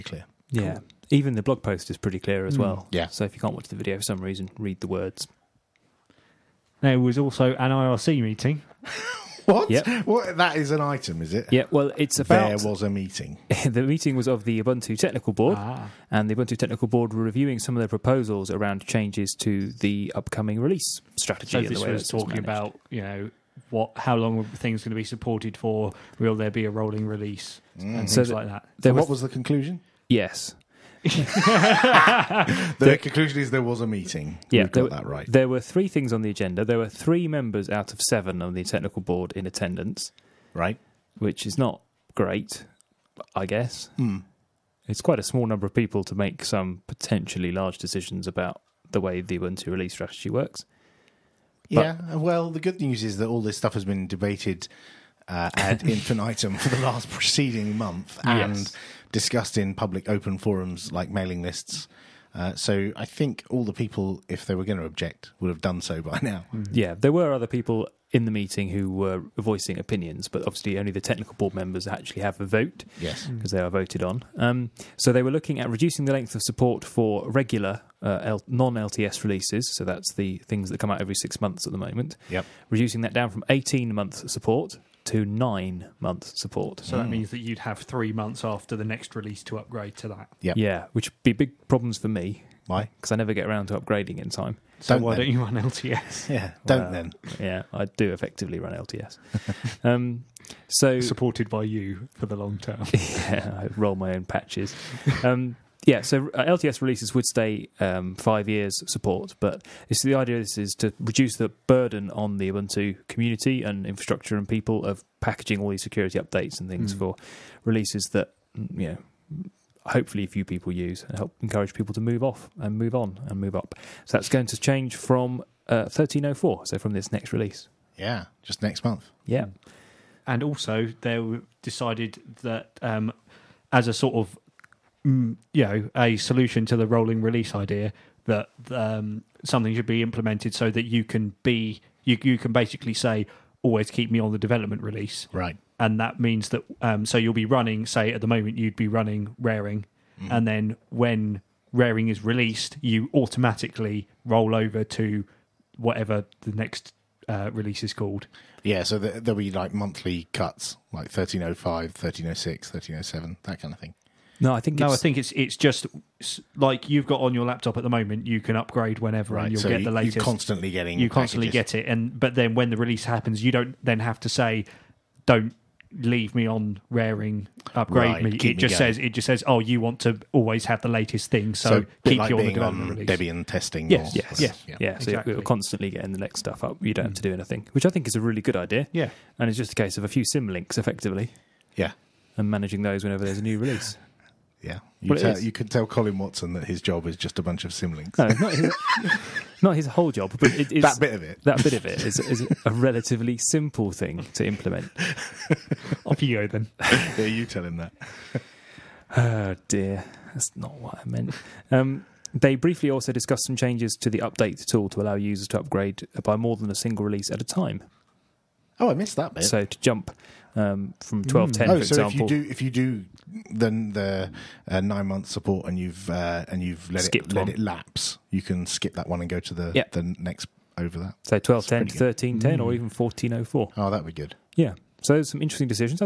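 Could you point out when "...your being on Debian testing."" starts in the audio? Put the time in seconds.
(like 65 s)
182 s.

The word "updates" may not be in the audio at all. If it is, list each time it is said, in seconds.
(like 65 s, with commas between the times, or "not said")
116 s, 214 s.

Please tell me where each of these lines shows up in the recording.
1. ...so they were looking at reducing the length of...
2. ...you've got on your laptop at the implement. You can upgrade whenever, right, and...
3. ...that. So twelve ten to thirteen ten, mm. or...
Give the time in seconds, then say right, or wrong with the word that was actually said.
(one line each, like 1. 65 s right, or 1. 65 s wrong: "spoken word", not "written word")
1. 74 s right
2. 166 s wrong: "moment", not "implement"
3. 230 s right.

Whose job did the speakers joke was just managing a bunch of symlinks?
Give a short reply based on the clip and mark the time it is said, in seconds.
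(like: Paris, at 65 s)
Colin Watson, at 195 s.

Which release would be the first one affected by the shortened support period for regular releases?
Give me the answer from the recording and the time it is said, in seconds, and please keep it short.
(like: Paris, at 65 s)
13.04, at 125 s.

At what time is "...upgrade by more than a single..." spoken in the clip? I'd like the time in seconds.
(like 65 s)
215 s.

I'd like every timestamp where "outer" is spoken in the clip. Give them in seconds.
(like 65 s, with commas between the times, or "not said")
not said.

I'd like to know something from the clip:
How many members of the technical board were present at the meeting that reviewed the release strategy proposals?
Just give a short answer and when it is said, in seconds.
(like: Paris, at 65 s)
3, at 36 s.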